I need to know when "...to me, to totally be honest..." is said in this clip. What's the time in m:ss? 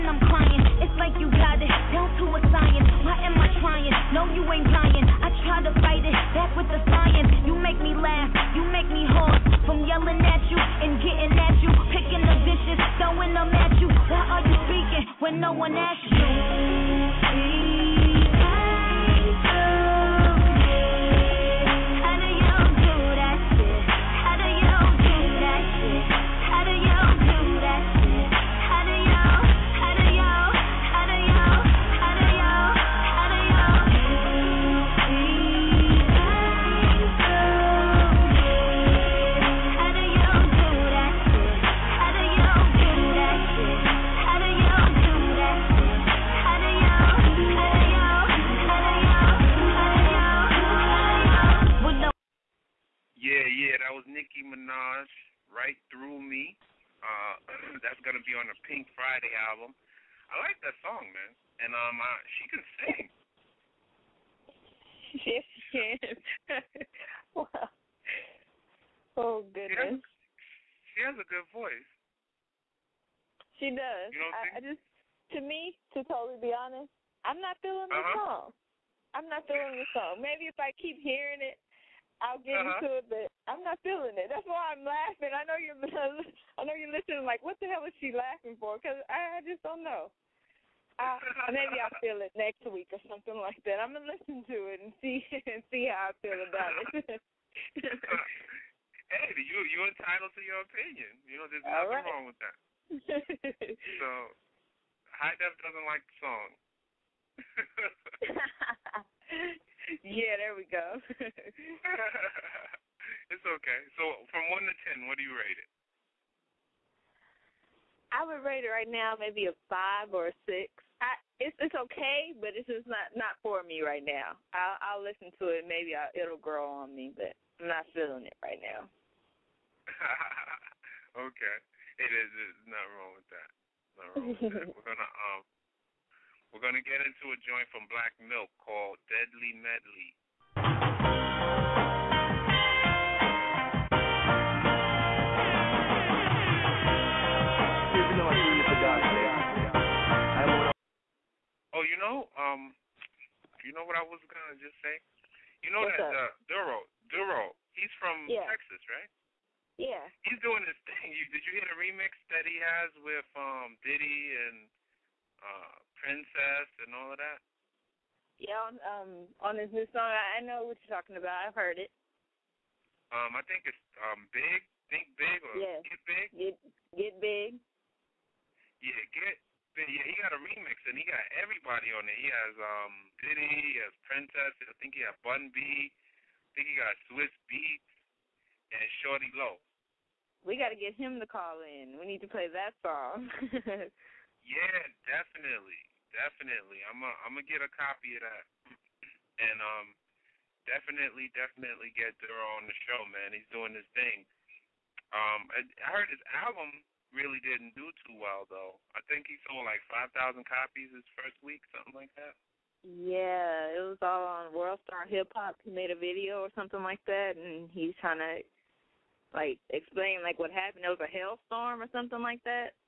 1:15.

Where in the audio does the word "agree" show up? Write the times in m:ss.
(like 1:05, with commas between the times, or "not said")
not said.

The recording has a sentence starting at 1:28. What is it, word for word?
Because I, I just don't know.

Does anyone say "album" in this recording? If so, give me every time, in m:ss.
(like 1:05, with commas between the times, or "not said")
0:59, 3:26.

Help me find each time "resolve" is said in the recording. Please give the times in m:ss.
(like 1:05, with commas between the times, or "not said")
not said.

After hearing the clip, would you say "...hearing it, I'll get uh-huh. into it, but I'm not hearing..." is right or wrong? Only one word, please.
wrong.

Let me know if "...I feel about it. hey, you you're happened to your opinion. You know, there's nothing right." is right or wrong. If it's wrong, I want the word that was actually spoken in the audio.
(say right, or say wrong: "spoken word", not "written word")
wrong: "entitled", not "happened".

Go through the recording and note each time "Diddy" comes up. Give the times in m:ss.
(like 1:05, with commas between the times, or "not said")
2:43, 3:03.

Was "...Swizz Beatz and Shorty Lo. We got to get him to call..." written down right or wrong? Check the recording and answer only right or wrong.
right.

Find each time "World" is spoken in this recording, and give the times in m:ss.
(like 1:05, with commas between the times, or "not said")
3:34.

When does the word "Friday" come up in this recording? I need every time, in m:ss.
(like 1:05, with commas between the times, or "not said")
0:58.